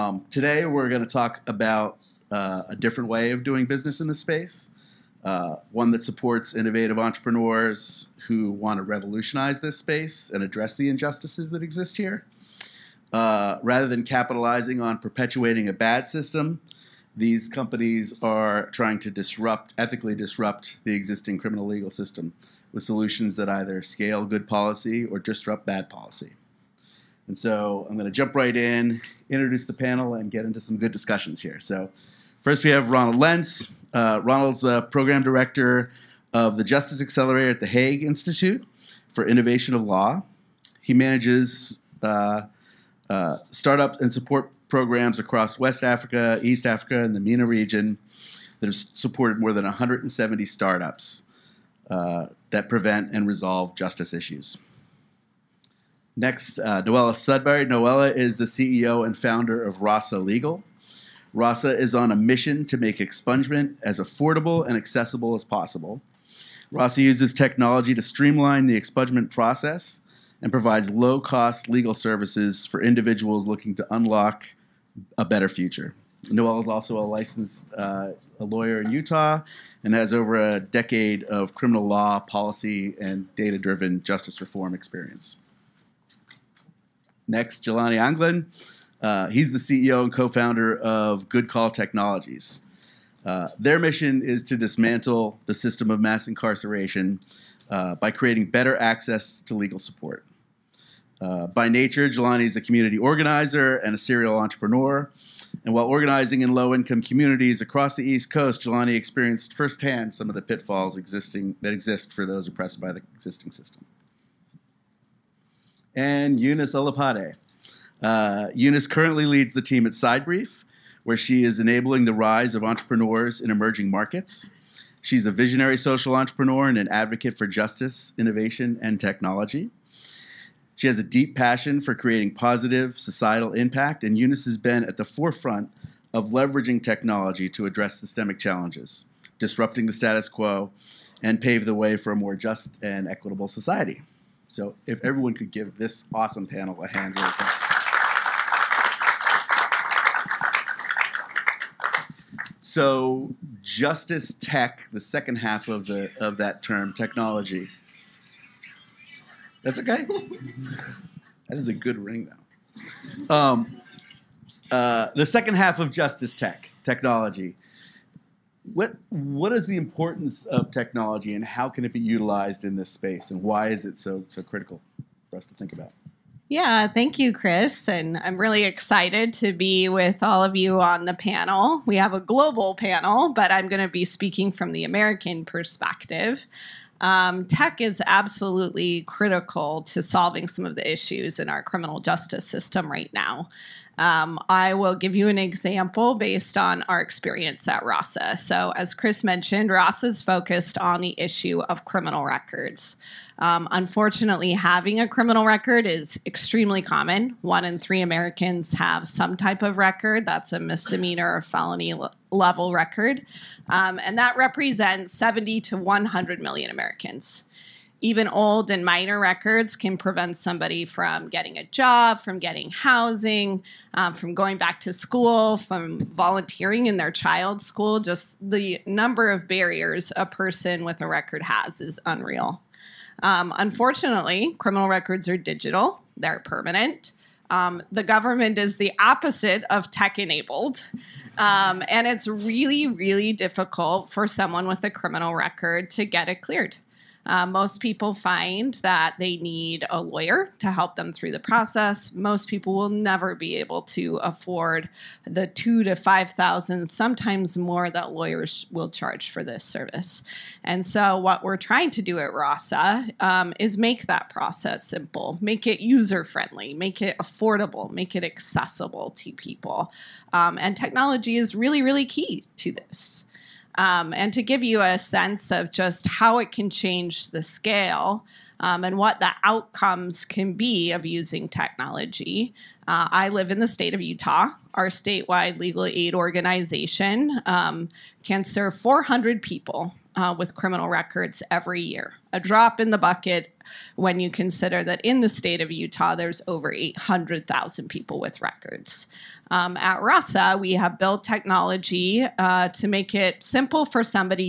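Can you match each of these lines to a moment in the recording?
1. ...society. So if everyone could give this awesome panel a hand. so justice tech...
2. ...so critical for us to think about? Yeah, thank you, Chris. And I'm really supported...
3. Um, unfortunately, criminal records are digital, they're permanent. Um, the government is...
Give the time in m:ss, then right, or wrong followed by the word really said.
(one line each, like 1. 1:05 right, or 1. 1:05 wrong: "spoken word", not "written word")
1. 2:23 right
2. 2:54 wrong: "excited", not "supported"
3. 3:53 right.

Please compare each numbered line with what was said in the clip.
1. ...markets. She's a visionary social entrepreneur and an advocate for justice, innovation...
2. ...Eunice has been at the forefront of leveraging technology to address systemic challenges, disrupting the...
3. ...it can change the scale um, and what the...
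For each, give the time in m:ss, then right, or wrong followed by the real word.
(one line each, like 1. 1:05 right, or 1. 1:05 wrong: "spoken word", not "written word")
1. 2:03 right
2. 2:14 right
3. 4:36 right.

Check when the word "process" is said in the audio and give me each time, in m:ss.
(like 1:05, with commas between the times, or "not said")
1:09, 4:11, 4:24.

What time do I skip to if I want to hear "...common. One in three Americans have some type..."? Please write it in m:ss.
3:26.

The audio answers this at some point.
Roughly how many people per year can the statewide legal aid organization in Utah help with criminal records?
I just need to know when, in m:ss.
4:48.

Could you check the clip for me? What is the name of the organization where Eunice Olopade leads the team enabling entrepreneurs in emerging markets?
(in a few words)
Sidebrief.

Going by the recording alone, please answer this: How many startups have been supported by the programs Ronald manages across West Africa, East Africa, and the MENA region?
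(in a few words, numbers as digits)
170.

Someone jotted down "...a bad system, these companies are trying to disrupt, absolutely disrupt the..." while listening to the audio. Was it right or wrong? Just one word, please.
wrong.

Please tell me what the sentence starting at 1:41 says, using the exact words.
Uh, by nature, Jelani is a community organizer and a serial entrepreneur.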